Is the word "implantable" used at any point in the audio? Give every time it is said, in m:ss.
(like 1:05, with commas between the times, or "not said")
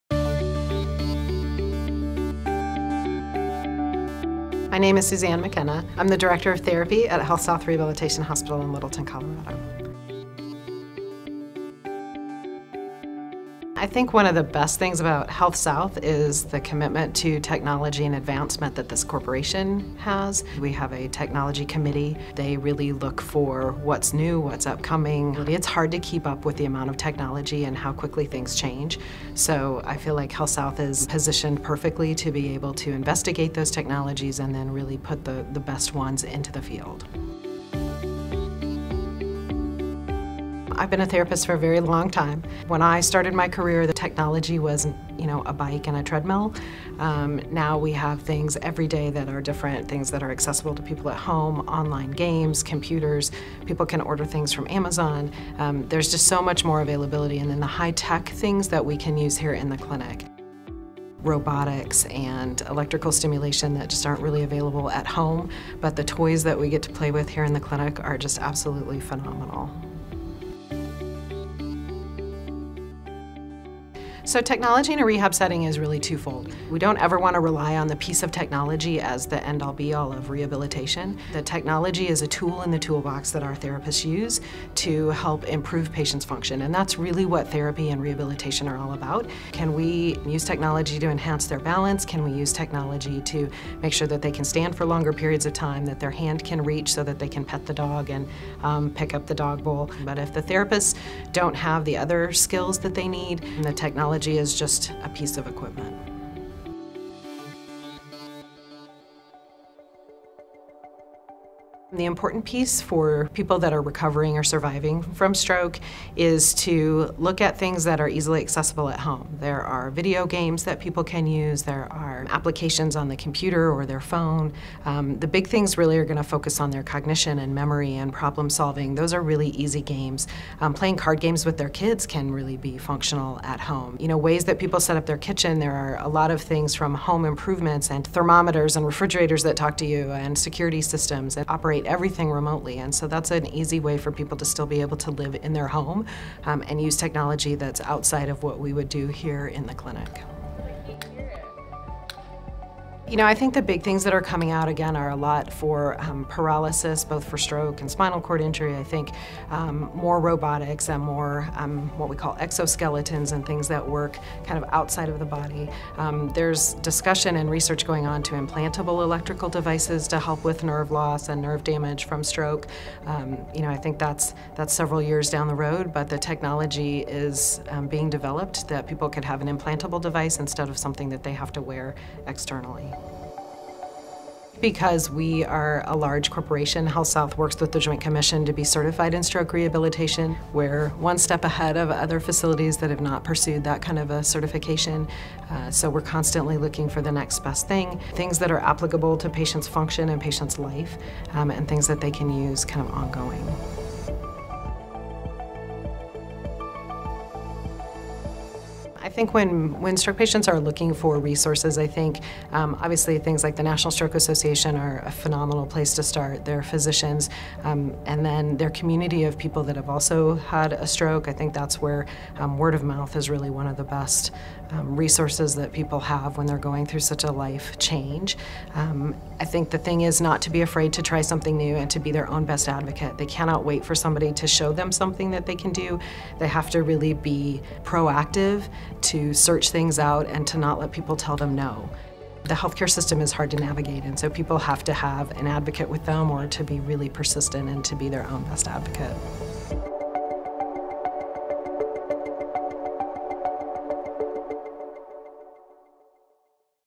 2:48, 2:59.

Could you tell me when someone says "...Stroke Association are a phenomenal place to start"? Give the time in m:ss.
3:33.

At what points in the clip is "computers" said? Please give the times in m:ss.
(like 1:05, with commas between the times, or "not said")
0:52, 2:03.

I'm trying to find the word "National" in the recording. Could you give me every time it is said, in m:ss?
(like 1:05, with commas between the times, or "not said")
3:33.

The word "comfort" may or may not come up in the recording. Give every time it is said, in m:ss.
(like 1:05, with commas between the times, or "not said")
not said.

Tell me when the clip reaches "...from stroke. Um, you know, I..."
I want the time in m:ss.
2:52.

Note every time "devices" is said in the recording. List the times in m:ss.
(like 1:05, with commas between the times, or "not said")
2:49, 3:00.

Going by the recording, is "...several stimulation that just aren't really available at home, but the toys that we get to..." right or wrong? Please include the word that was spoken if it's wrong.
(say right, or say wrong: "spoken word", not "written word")
wrong: "electrical", not "several".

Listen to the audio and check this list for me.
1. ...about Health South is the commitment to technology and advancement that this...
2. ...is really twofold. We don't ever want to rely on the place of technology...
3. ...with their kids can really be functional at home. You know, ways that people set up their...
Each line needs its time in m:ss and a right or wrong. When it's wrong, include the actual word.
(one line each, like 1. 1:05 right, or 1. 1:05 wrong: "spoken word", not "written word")
1. 0:14 right
2. 1:15 wrong: "piece", not "place"
3. 2:11 right.